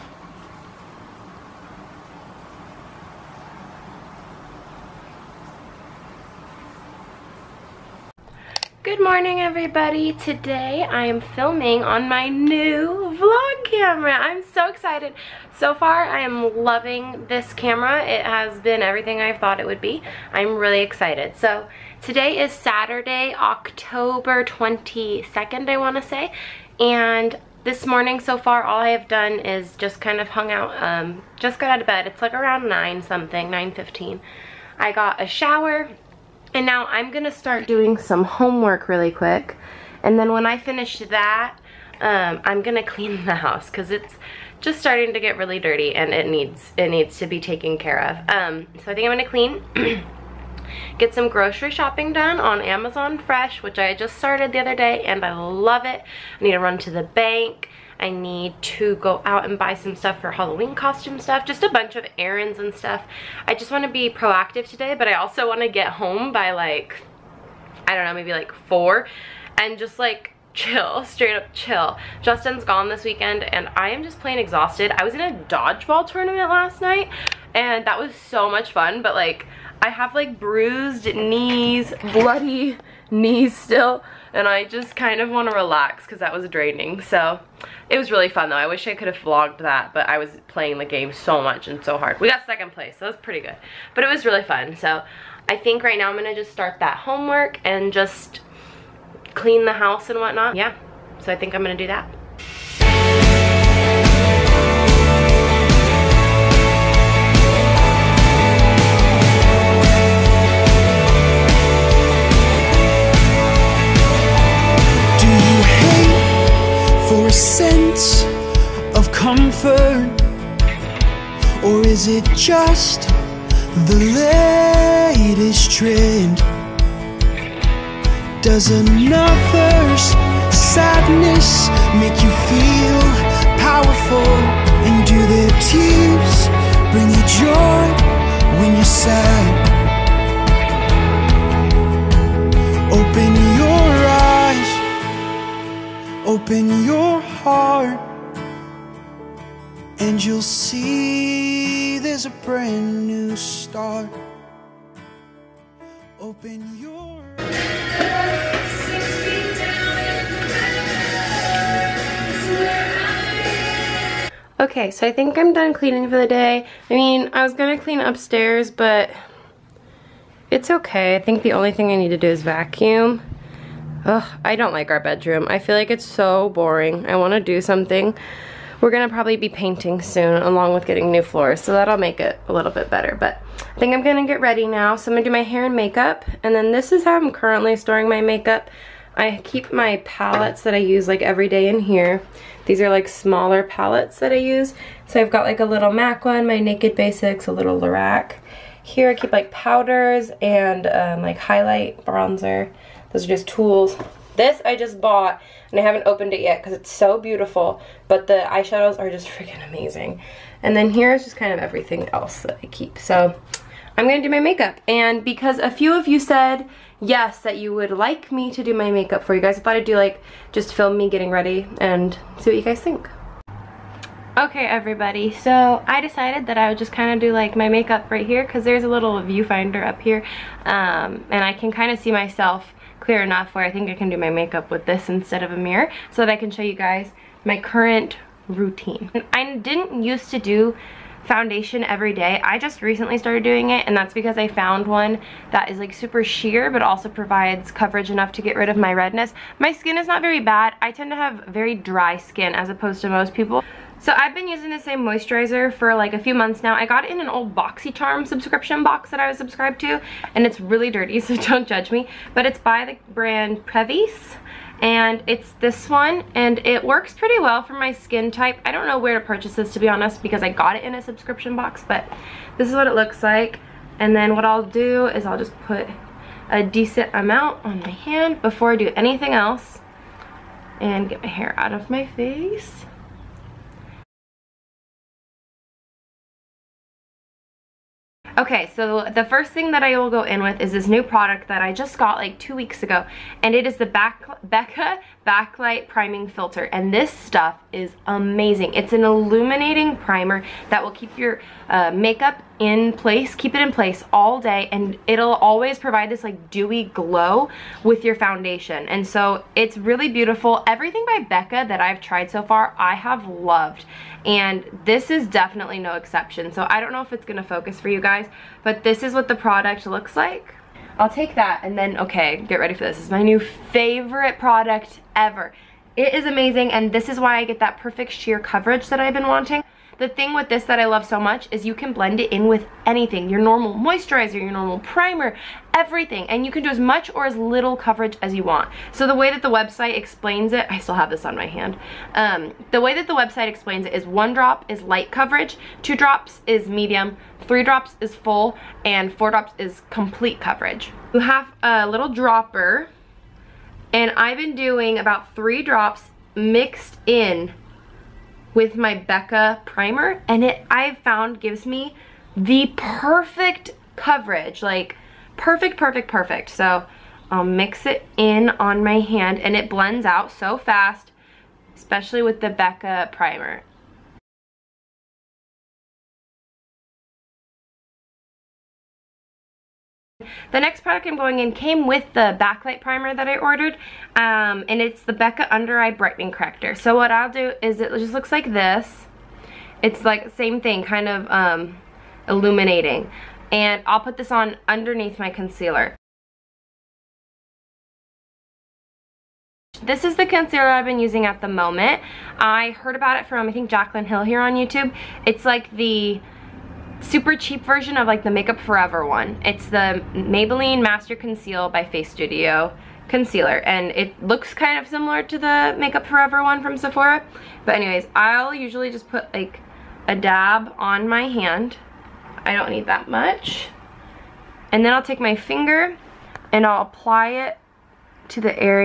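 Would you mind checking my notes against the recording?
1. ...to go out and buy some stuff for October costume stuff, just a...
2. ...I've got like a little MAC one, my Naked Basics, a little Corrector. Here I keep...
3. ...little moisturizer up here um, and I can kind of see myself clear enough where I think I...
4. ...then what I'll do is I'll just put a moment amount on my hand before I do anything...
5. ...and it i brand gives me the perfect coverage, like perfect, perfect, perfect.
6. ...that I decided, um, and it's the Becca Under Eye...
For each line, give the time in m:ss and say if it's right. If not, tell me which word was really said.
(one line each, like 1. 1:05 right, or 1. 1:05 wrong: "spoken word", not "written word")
1. 0:58 wrong: "Halloween", not "October"
2. 3:15 wrong: "Lorac", not "Corrector"
3. 3:48 wrong: "viewfinder", not "moisturizer"
4. 4:34 wrong: "decent", not "moment"
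5. 6:00 wrong: "found", not "brand"
6. 6:23 wrong: "ordered", not "decided".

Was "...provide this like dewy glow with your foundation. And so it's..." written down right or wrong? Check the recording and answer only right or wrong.
right.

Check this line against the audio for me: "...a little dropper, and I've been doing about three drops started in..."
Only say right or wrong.
wrong.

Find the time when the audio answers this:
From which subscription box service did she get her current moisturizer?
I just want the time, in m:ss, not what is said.
4:17.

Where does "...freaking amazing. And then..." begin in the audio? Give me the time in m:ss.
3:29.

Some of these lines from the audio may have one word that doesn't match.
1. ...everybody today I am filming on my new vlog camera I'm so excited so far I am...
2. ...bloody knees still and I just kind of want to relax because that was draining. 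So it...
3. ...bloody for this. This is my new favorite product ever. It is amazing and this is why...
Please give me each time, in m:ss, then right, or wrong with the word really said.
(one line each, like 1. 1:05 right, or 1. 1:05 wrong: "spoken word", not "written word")
1. 0:09 right
2. 1:22 right
3. 5:22 wrong: "ready", not "bloody".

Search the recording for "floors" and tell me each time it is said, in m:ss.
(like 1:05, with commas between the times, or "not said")
3:01.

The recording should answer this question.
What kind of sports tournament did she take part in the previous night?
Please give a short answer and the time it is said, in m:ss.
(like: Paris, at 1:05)
Dodgeball, at 1:15.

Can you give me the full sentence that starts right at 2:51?
I think the only thing I need to do is vacuum.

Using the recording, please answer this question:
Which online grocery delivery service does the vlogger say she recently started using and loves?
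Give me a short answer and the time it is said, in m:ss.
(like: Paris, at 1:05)
Amazon Fresh, at 0:52.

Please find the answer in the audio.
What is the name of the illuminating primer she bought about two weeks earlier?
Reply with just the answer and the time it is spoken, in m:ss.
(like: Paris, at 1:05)
Becca Backlight Priming Filter, at 4:54.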